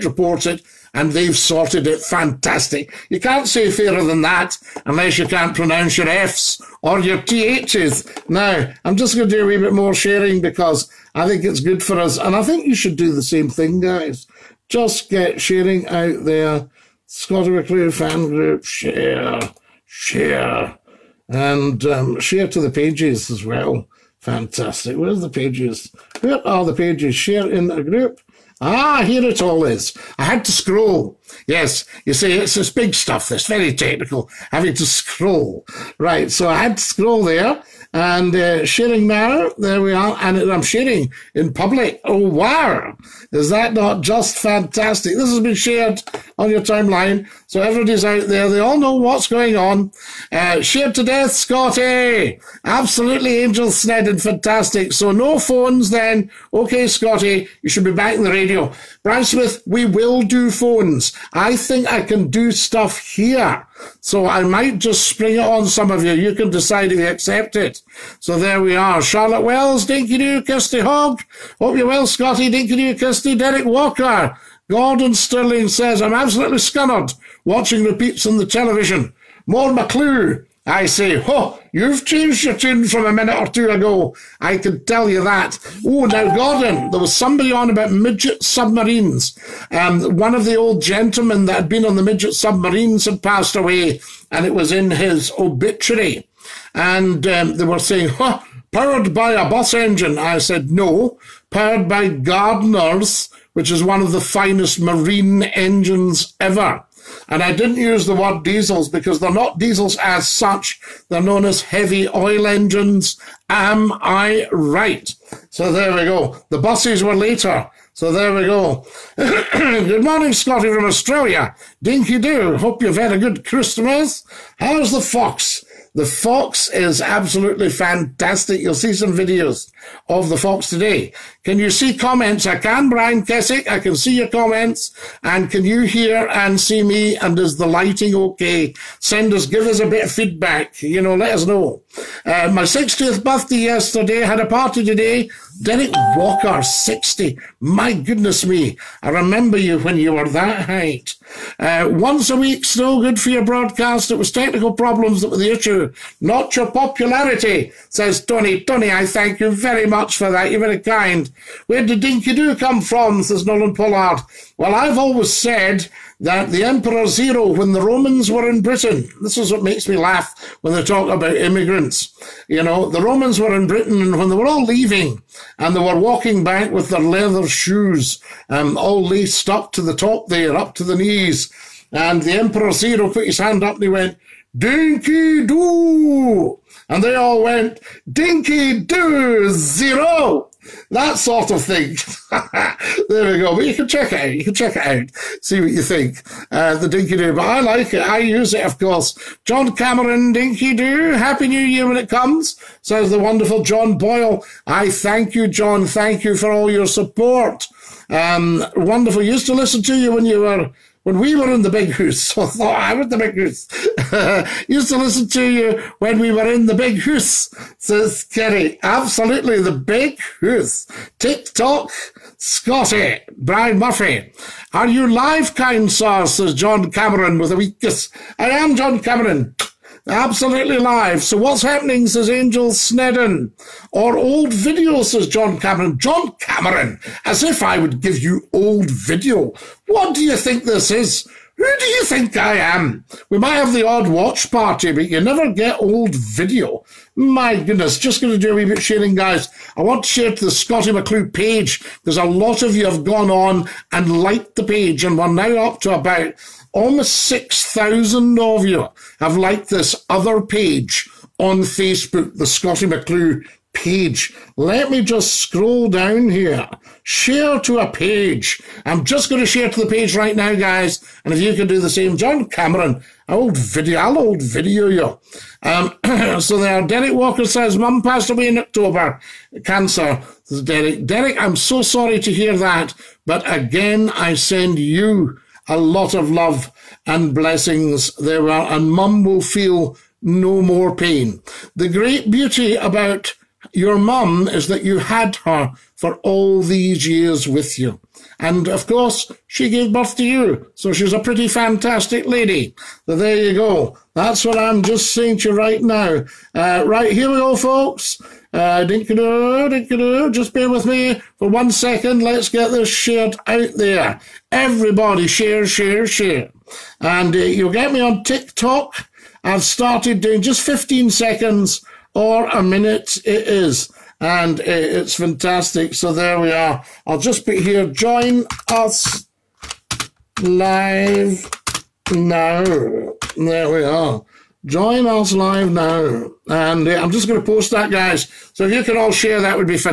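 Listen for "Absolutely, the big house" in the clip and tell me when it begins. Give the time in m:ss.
3:38.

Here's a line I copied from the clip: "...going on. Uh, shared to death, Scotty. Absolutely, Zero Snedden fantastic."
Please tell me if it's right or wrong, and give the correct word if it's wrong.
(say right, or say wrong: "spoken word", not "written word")
wrong: "Angel", not "Zero".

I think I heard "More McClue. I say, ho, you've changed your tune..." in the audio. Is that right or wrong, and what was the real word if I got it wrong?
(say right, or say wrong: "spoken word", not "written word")
right.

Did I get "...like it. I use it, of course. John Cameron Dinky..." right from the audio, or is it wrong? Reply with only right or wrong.
right.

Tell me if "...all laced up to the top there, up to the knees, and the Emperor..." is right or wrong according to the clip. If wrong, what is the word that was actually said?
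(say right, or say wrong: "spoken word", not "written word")
right.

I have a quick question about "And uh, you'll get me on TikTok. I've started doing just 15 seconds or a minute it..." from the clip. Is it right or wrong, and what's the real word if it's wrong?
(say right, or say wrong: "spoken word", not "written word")
right.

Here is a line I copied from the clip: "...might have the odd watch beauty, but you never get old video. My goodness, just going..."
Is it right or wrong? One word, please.
wrong.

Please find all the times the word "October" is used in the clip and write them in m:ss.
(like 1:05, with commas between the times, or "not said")
4:38.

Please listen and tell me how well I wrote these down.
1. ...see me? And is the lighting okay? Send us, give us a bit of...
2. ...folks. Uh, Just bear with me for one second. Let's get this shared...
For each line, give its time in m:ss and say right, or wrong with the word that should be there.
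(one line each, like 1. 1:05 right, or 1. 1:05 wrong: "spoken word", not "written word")
1. 2:16 right
2. 5:07 right.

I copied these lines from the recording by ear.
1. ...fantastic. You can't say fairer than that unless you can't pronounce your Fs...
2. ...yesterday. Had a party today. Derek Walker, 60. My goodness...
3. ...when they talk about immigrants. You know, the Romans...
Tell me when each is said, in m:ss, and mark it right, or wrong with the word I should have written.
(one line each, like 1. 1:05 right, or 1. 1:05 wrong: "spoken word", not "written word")
1. 0:02 right
2. 2:23 right
3. 2:50 right.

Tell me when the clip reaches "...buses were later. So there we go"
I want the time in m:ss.
1:56.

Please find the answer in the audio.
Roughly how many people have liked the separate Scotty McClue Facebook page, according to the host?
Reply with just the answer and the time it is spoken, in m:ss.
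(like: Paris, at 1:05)
almost 6,000, at 4:16.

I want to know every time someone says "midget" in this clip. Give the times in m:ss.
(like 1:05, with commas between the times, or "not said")
1:27, 1:32.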